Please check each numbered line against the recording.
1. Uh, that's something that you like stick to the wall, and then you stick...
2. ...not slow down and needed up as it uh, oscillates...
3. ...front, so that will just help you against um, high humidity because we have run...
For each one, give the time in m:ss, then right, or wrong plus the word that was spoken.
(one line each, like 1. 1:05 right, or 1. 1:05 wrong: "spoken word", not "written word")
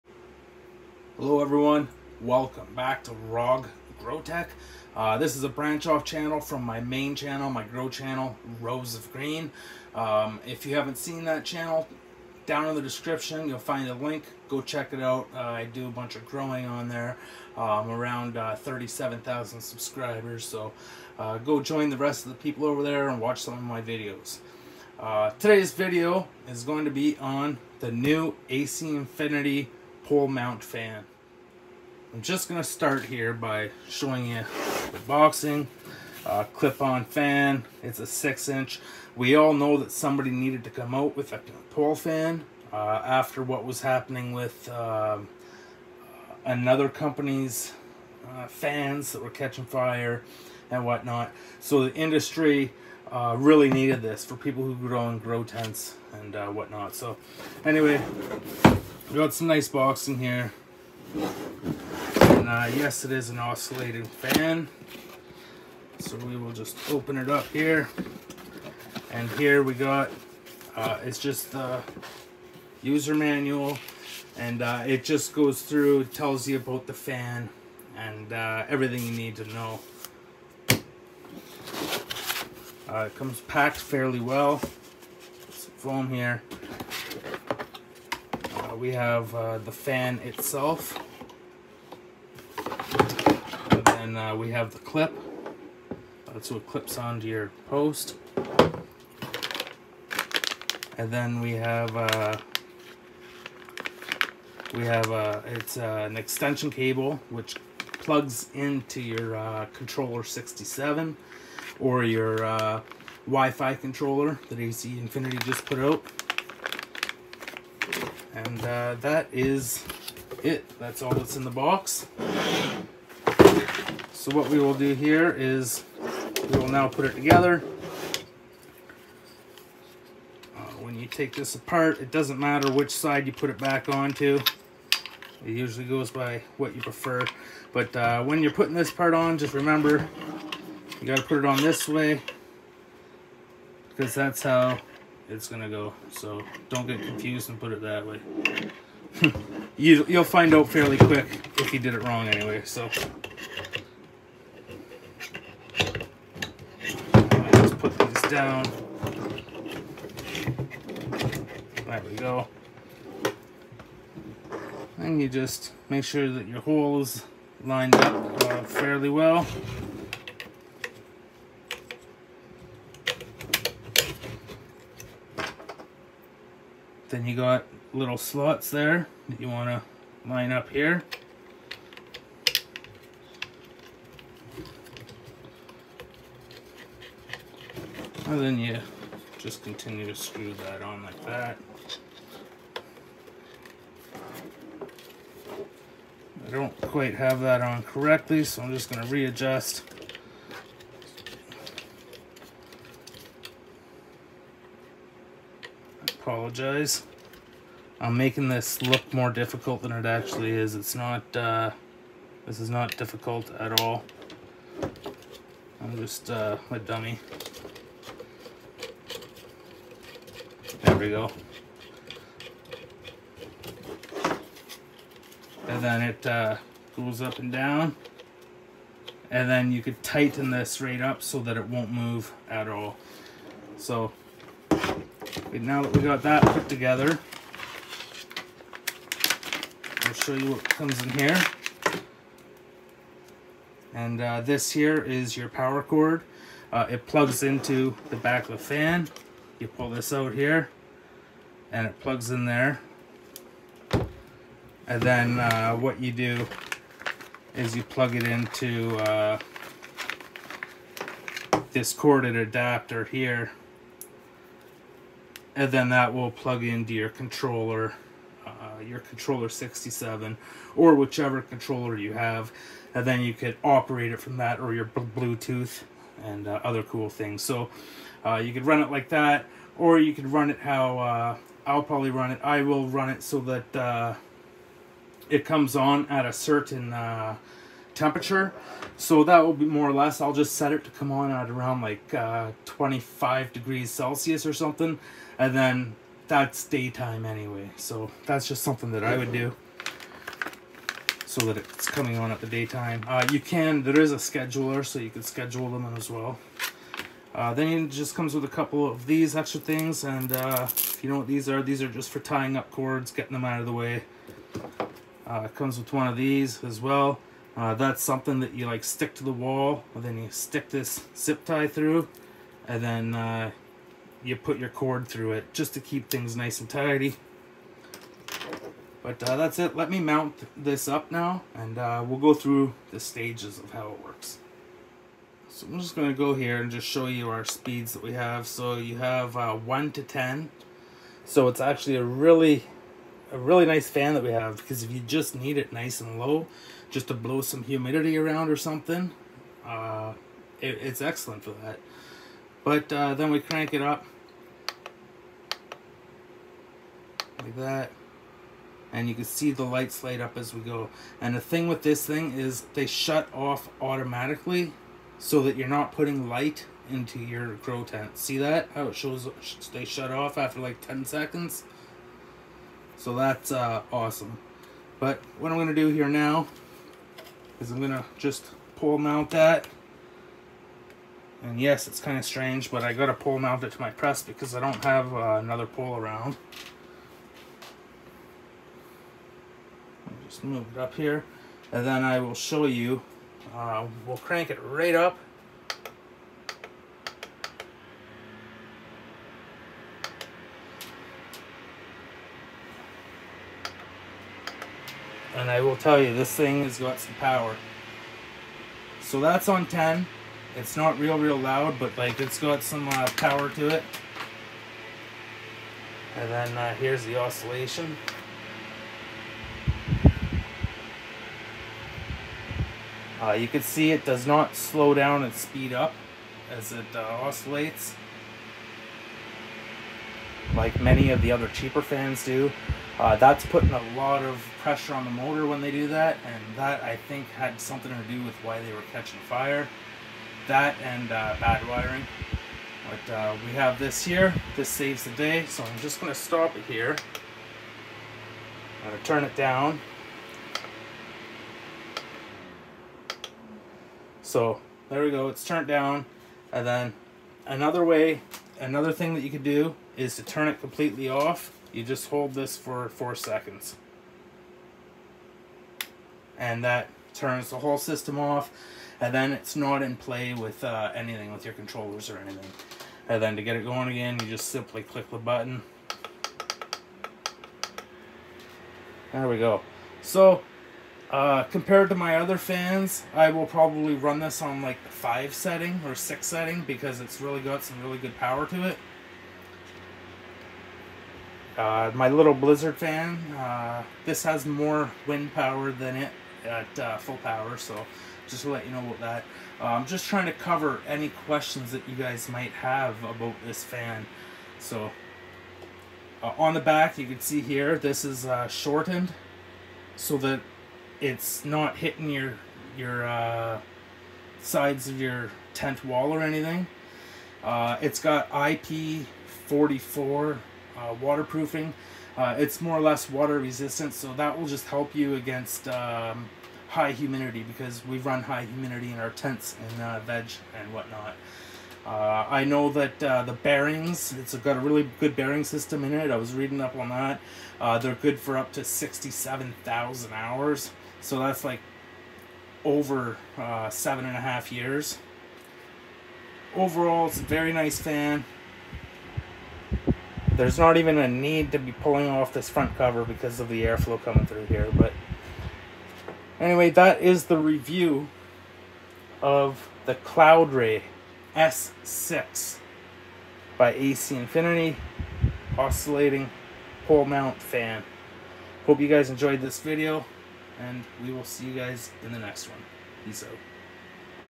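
1. 5:17 right
2. 7:04 wrong: "speed", not "needed"
3. 8:43 wrong: "resistant", not "front".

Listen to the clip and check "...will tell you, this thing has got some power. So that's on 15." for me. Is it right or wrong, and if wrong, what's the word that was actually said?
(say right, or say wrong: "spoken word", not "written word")
wrong: "10", not "15".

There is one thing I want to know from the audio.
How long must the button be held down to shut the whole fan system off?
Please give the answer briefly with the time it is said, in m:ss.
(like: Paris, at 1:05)
4 seconds, at 7:42.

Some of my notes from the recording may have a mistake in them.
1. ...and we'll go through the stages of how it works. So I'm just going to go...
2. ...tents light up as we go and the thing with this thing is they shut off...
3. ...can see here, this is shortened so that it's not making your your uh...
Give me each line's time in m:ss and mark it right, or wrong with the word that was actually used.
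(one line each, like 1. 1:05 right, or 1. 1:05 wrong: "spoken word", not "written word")
1. 5:31 right
2. 5:59 wrong: "lights", not "tents"
3. 8:27 wrong: "hitting", not "making".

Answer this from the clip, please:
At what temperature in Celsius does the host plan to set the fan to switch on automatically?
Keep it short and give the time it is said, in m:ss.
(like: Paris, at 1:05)
25 degrees Celsius, at 4:52.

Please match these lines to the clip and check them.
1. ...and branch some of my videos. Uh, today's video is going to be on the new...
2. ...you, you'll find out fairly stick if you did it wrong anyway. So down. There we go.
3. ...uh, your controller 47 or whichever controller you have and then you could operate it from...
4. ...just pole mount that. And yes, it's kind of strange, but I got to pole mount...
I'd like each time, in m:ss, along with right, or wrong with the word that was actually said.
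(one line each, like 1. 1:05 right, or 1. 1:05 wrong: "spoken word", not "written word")
1. 0:23 wrong: "watch", not "branch"
2. 2:29 wrong: "quick", not "stick"
3. 4:28 wrong: "67", not "47"
4. 6:18 right.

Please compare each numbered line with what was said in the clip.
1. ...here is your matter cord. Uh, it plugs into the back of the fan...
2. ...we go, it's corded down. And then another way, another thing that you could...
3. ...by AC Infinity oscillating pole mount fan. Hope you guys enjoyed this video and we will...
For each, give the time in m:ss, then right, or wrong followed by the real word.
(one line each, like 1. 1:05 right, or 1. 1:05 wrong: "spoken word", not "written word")
1. 4:04 wrong: "power", not "matter"
2. 7:35 wrong: "turned", not "corded"
3. 9:23 right.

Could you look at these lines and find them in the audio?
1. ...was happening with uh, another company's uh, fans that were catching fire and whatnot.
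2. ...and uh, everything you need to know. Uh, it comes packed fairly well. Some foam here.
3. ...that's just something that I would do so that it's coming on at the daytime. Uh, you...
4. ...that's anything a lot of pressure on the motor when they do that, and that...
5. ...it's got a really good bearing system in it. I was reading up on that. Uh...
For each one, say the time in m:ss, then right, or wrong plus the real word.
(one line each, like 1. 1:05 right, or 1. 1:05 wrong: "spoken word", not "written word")
1. 0:43 right
2. 1:17 right
3. 4:58 right
4. 7:13 wrong: "putting", not "anything"
5. 8:54 right.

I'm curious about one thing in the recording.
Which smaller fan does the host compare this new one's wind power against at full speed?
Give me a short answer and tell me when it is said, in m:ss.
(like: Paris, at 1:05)
Blizzard, at 8:12.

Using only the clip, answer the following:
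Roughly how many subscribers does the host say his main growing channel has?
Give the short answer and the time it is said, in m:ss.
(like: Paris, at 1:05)
37,000, at 0:18.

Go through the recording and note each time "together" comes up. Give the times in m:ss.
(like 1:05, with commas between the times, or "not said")
2:07, 3:56.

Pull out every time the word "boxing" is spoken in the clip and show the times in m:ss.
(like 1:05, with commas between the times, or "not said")
0:35, 0:59.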